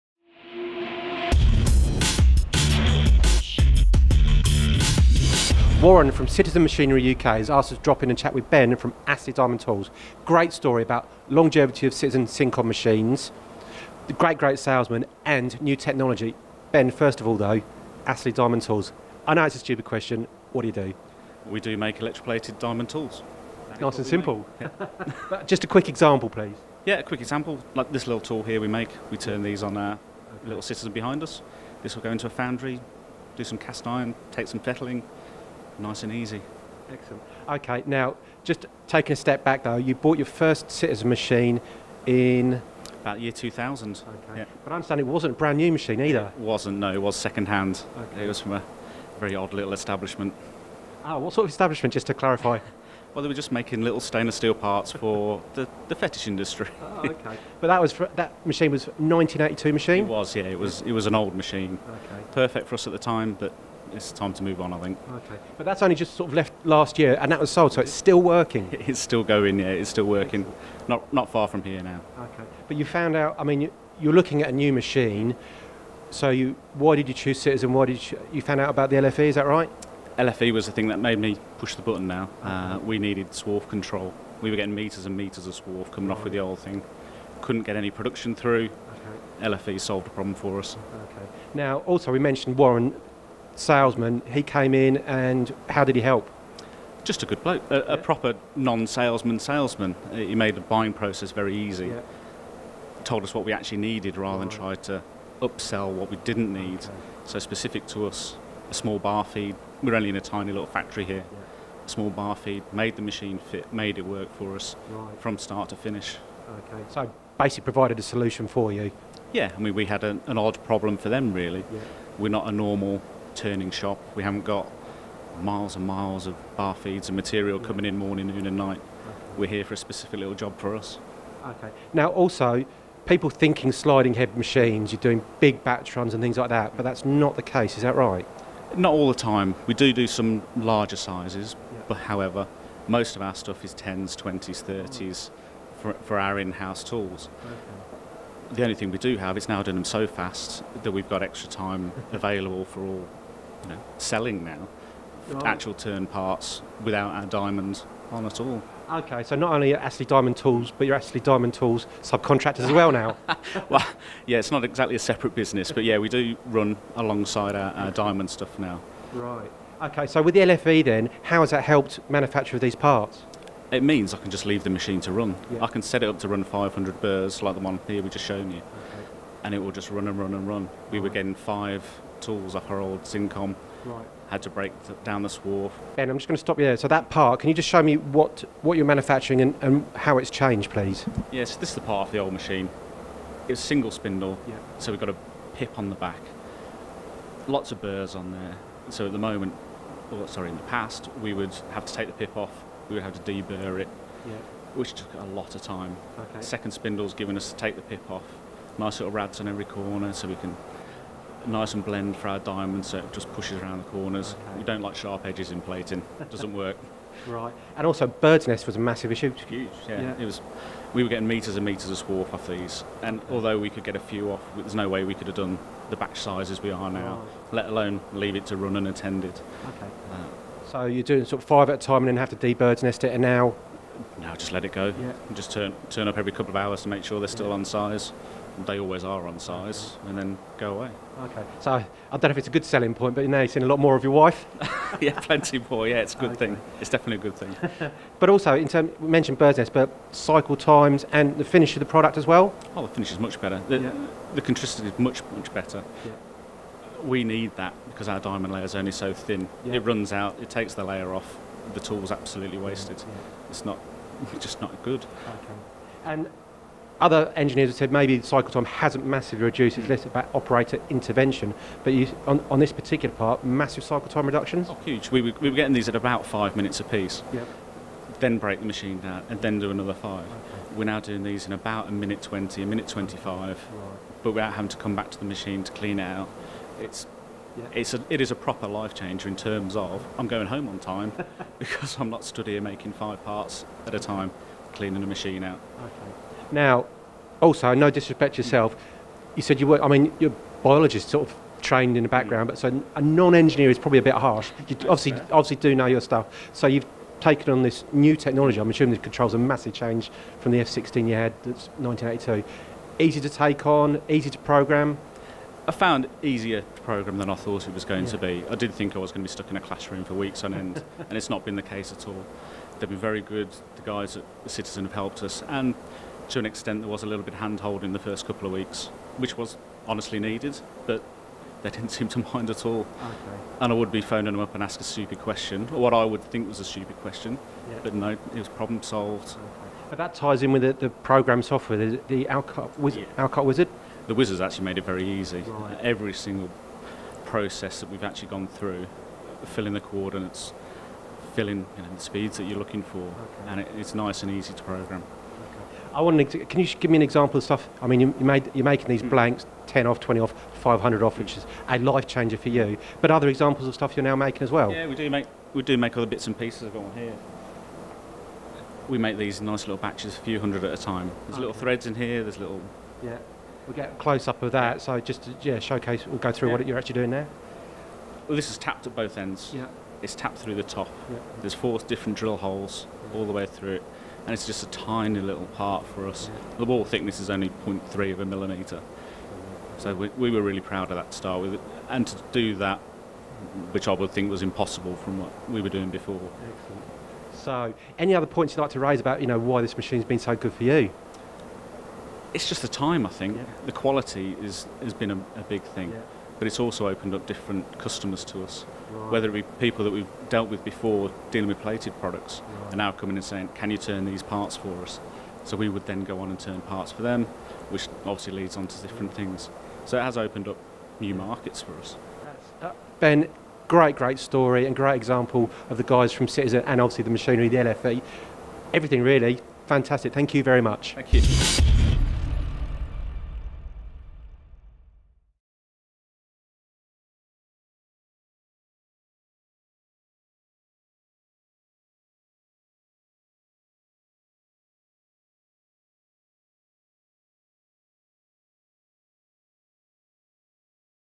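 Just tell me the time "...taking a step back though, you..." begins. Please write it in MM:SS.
00:38.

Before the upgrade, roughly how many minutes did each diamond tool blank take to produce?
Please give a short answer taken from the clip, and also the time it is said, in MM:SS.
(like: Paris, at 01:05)
5 minutes, at 04:36.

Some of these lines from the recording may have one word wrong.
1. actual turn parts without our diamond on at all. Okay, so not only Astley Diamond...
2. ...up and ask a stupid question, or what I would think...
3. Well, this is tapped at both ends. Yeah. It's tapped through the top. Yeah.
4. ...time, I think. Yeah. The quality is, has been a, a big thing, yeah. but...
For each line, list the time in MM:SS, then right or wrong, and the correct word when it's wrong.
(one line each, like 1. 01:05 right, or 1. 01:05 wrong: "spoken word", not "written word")
1. 02:35 right
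2. 05:34 right
3. 06:18 right
4. 06:42 right.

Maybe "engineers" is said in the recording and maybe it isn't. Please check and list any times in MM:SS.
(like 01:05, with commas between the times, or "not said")
04:27, 05:03.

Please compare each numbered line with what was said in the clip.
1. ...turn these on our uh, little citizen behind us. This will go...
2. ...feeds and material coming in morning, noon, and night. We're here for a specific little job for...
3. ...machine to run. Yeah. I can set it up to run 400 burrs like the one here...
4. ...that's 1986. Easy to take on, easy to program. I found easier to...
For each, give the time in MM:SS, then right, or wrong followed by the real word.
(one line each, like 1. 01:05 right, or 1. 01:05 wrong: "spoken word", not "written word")
1. 00:29 right
2. 02:06 right
3. 02:54 wrong: "500", not "400"
4. 05:11 wrong: "1982", not "1986".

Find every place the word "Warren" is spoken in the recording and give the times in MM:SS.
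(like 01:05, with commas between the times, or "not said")
00:05, 01:32.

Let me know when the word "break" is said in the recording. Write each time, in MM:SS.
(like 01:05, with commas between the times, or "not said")
03:04, 04:38.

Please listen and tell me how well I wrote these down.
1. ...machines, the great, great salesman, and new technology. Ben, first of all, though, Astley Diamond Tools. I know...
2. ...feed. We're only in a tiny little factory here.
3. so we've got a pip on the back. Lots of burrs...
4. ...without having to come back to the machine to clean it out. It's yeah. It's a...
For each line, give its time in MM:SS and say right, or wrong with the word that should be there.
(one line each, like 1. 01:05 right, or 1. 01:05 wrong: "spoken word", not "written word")
1. 00:12 right
2. 01:49 right
3. 03:14 right
4. 04:44 right.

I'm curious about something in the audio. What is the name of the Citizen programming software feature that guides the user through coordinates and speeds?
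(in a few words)
Wizard.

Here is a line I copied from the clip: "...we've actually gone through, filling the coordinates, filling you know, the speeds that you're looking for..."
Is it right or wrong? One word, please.
right.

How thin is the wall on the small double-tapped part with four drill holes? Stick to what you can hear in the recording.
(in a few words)
0.3 mm.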